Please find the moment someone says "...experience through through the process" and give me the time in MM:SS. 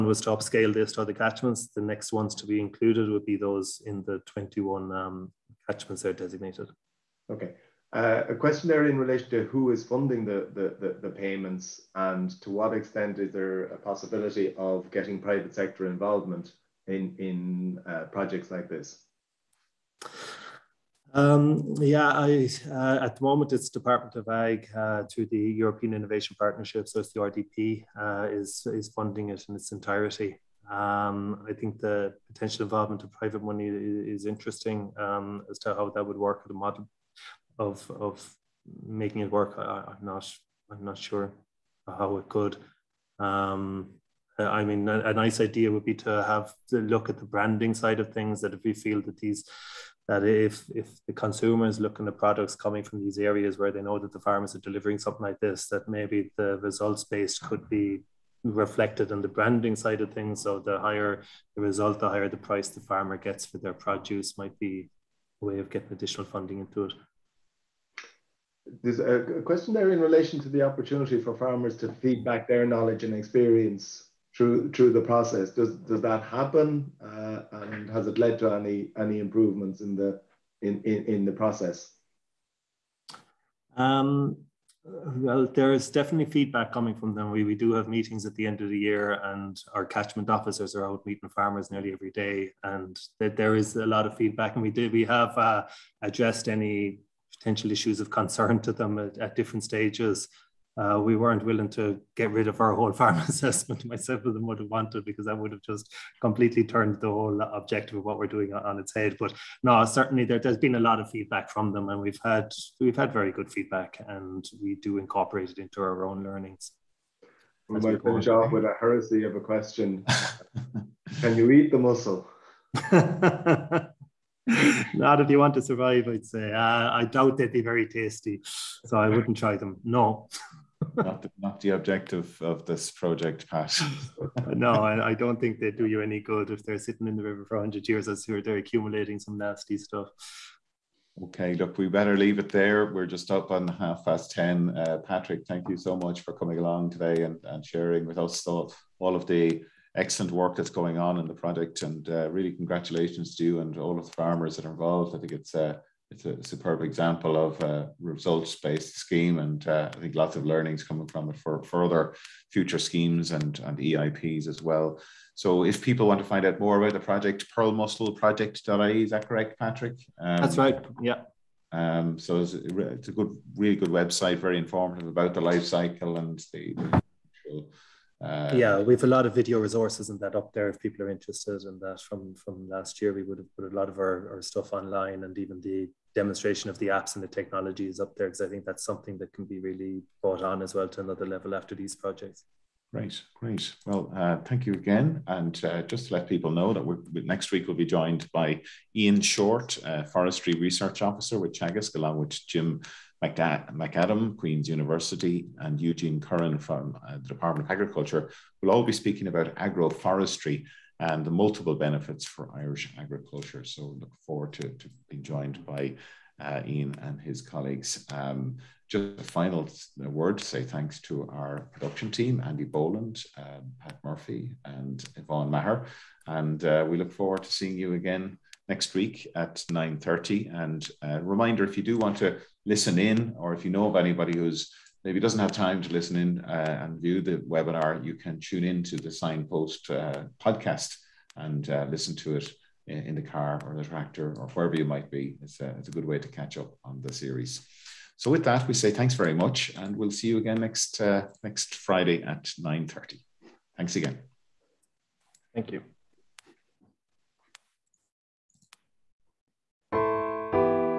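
01:13.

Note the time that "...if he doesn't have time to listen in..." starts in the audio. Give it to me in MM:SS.
03:55.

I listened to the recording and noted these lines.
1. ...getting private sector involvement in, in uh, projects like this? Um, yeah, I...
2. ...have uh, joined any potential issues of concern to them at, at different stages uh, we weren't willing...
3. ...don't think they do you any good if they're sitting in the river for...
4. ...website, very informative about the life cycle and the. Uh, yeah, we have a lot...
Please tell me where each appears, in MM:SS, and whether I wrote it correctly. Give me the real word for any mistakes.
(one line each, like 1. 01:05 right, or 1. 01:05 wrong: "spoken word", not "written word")
1. 00:14 right
2. 01:35 wrong: "addressed", not "joined"
3. 02:15 right
4. 02:53 right.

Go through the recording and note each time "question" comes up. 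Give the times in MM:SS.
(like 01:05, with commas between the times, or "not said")
00:08, 01:09, 01:59.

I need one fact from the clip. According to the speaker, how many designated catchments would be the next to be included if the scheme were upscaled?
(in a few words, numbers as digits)
21.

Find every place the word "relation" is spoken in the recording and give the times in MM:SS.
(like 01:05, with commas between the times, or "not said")
00:08, 01:09.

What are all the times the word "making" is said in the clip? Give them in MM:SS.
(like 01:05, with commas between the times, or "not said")
00:38.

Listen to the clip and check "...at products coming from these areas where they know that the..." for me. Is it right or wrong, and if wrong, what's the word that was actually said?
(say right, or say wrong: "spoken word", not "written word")
right.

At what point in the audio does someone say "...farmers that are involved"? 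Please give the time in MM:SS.
02:34.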